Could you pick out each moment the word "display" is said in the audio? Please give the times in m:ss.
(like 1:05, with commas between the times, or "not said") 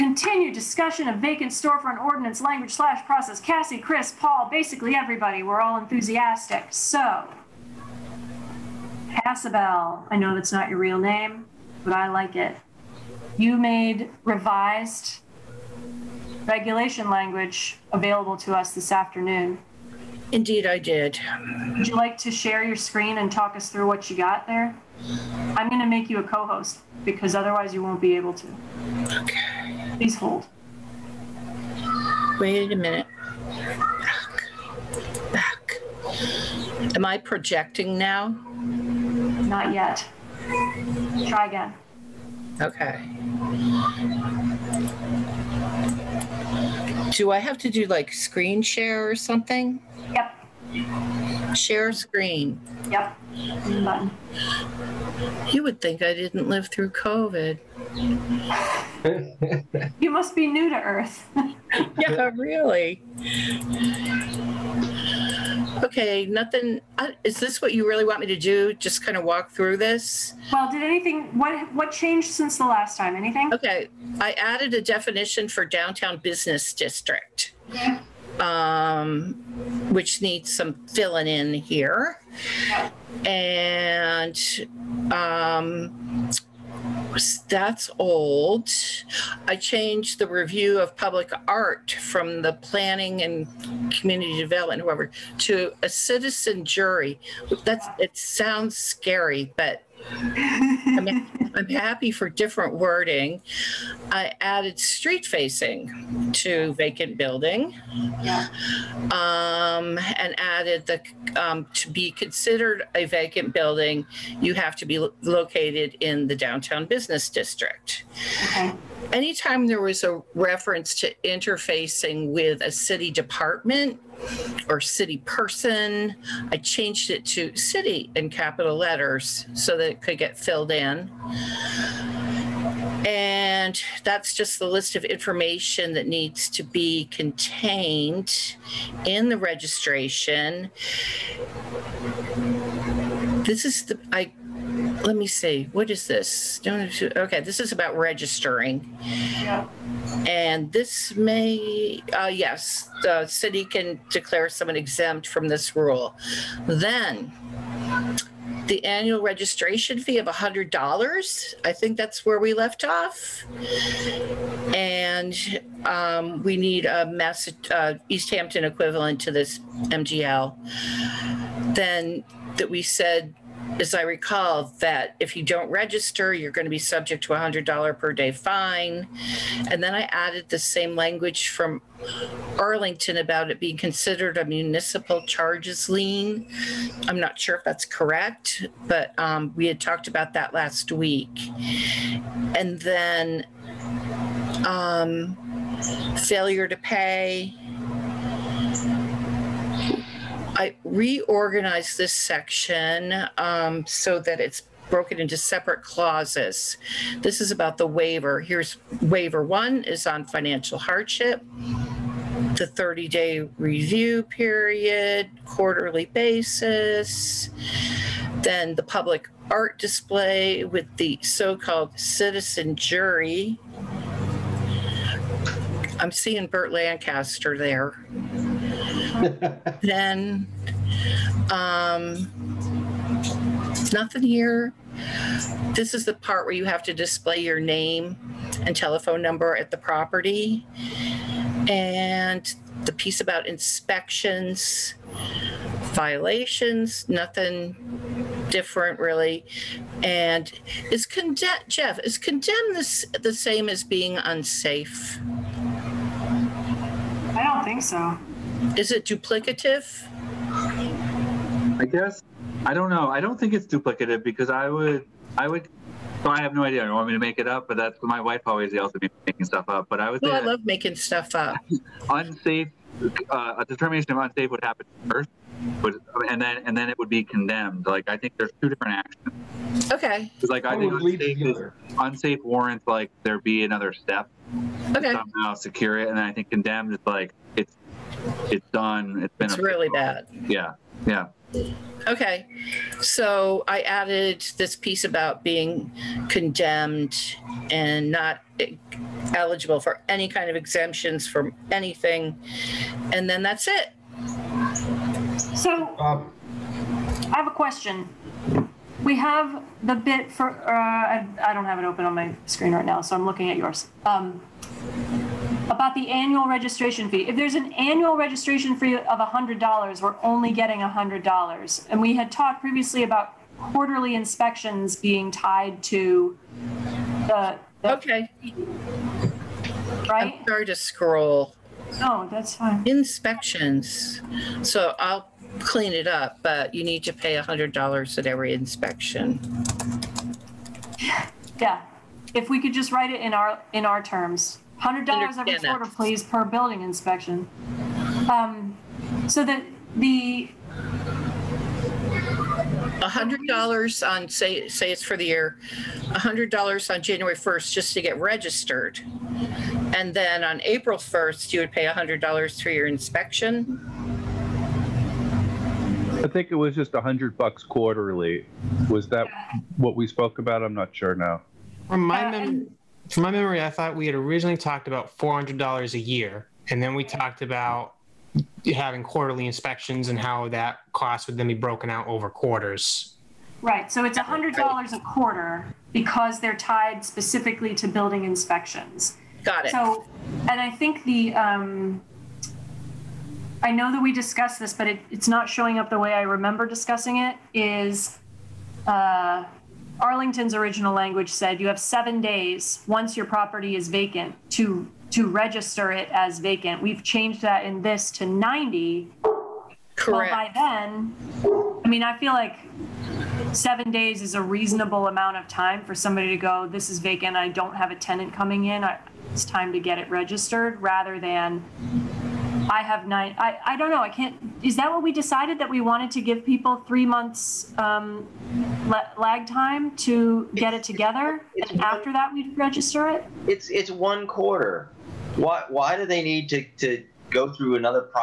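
3:39, 3:56.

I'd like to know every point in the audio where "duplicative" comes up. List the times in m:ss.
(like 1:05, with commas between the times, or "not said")
4:19, 4:23.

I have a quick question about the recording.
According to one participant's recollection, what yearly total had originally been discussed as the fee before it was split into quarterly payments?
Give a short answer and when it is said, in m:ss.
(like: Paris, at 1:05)
$400, at 6:15.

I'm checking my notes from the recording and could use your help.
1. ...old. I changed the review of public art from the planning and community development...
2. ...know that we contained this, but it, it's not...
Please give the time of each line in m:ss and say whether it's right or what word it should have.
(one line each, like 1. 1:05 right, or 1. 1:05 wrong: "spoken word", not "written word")
1. 1:27 right
2. 6:33 wrong: "discussed", not "contained".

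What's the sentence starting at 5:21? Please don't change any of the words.
And we had talked previously about quarterly inspections being tied to the.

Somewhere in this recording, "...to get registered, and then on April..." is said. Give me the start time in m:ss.
5:57.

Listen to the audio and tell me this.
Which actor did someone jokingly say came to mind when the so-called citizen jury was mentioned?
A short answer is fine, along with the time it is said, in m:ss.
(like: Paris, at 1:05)
Burt Lancaster, at 3:46.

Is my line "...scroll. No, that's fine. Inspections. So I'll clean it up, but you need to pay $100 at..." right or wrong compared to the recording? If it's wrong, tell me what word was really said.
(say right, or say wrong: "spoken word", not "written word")
right.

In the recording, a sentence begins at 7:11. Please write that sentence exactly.
It's- And after that, we'd register it?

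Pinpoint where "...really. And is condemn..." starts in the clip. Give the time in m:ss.
4:08.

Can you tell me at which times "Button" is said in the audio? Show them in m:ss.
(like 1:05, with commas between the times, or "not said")
0:53.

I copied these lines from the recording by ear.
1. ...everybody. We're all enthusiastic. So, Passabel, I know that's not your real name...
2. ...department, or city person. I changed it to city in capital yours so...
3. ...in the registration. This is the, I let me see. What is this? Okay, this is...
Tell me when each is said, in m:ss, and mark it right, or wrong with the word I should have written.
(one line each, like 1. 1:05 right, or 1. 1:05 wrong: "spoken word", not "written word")
1. 0:04 right
2. 2:03 wrong: "letters", not "yours"
3. 2:19 right.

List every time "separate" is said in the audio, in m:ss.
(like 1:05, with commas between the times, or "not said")
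3:25.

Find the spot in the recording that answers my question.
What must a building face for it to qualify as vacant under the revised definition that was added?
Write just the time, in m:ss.
1:44.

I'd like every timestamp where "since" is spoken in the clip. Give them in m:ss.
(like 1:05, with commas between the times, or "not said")
1:12.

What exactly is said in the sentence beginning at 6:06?
I think it was just a hundred bucks quarterly.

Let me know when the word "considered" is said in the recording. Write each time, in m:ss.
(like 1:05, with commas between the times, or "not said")
1:52, 3:03.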